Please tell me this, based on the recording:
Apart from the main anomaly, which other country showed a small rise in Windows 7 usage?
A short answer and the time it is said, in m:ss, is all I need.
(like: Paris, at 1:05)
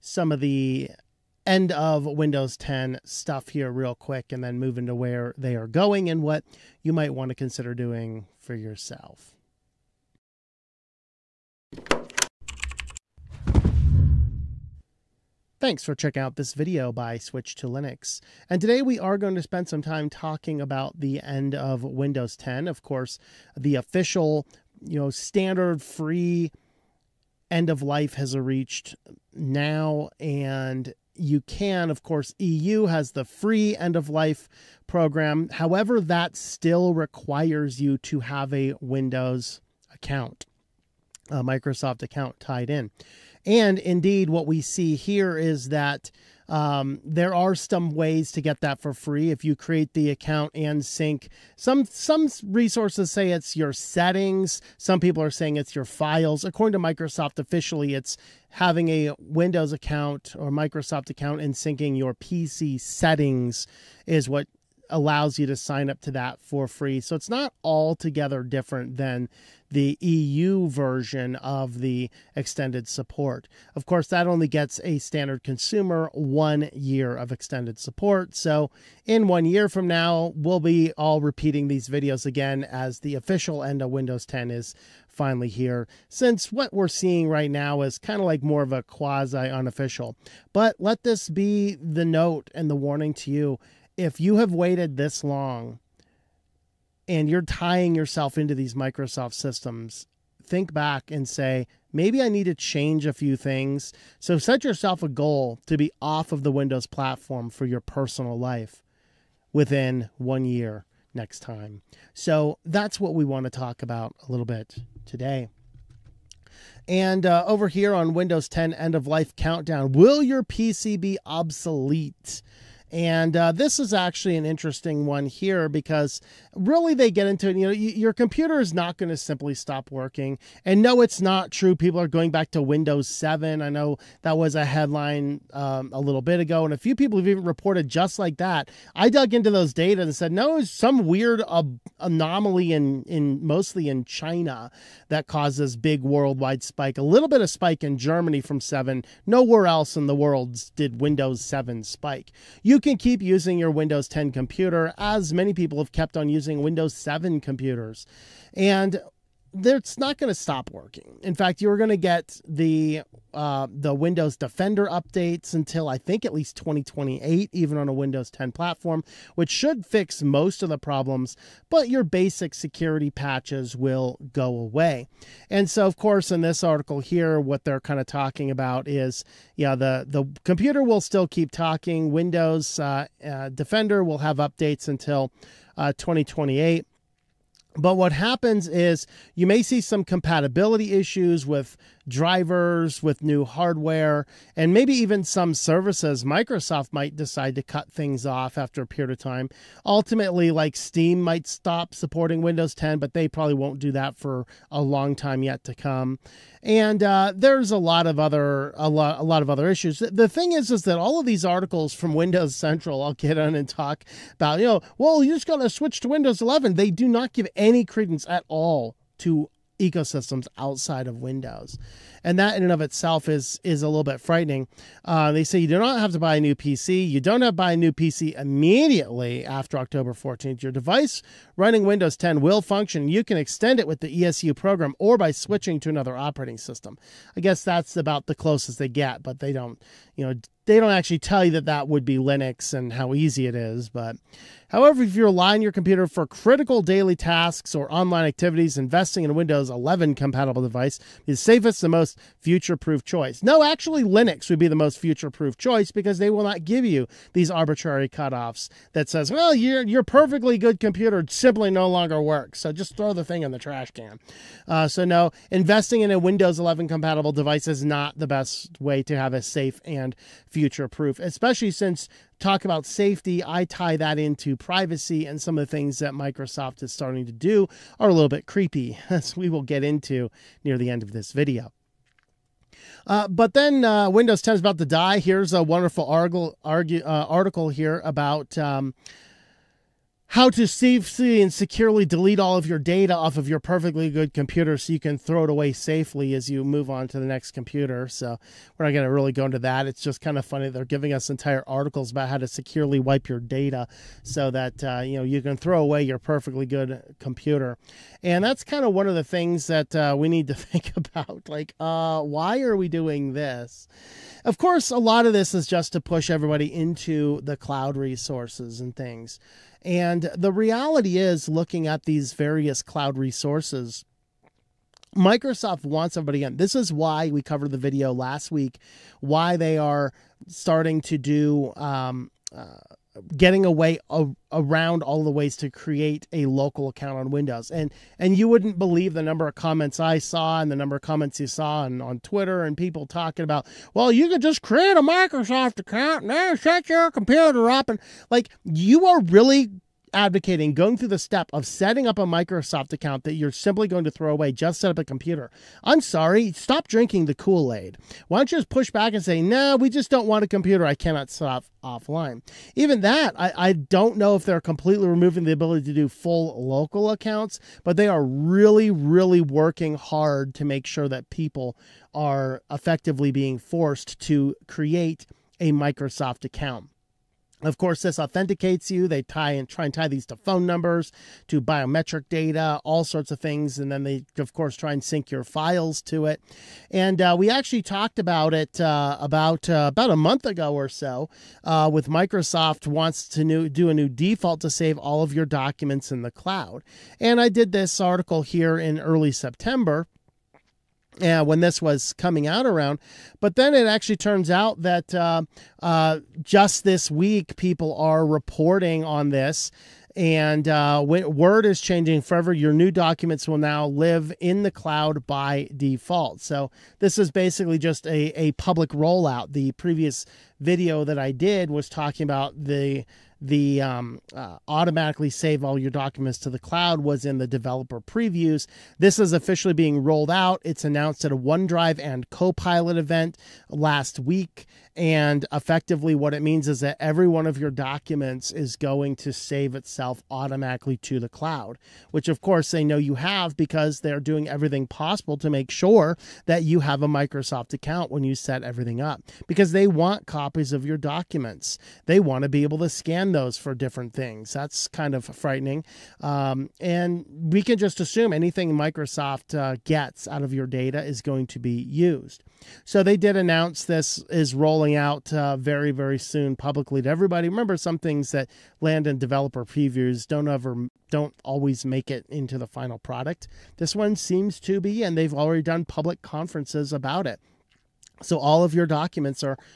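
Germany, at 2:27.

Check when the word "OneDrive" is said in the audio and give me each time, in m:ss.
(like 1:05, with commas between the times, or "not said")
7:11.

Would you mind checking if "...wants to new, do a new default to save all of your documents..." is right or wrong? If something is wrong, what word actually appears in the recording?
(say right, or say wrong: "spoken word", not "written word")
right.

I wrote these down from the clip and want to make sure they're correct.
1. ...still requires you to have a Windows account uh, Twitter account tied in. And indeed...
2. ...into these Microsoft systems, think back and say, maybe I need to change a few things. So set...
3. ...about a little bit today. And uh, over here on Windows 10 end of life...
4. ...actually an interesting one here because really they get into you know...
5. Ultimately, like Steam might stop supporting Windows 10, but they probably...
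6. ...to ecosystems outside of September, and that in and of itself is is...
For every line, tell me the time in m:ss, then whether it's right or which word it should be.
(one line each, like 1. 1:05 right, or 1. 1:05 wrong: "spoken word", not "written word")
1. 0:36 wrong: "Microsoft", not "Twitter"
2. 1:38 right
3. 1:53 right
4. 2:03 right
5. 3:19 right
6. 3:39 wrong: "Windows", not "September".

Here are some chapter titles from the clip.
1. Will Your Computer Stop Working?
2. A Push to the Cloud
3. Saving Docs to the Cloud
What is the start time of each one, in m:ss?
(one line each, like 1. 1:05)
1. 1:56
2. 5:18
3. 6:28.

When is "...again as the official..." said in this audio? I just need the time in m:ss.
1:22.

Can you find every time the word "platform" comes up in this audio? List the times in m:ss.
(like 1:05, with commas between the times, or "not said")
1:46, 2:48.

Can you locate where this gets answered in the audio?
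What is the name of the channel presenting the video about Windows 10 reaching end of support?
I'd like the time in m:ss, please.
0:17.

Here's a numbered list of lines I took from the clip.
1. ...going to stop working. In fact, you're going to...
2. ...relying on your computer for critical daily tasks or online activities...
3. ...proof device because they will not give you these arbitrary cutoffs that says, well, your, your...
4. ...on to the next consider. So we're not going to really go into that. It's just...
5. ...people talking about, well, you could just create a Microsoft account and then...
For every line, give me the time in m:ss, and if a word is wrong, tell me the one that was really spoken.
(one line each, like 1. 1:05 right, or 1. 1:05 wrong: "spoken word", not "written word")
1. 2:40 right
2. 4:05 right
3. 4:15 wrong: "choice", not "device"
4. 4:56 wrong: "computer", not "consider"
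5. 5:42 right.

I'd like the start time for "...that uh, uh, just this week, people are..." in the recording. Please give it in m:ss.
6:44.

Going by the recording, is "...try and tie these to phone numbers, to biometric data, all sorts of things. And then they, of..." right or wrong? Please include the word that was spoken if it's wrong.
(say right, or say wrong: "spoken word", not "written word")
right.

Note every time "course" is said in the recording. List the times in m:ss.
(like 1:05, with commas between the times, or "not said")
0:22, 0:32, 1:13, 2:55, 5:14, 6:17, 6:24, 7:22.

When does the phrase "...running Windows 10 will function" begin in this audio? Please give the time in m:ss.
3:51.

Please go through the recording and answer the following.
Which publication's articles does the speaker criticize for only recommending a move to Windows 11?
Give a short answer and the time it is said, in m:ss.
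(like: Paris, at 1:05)
Windows Central, at 3:32.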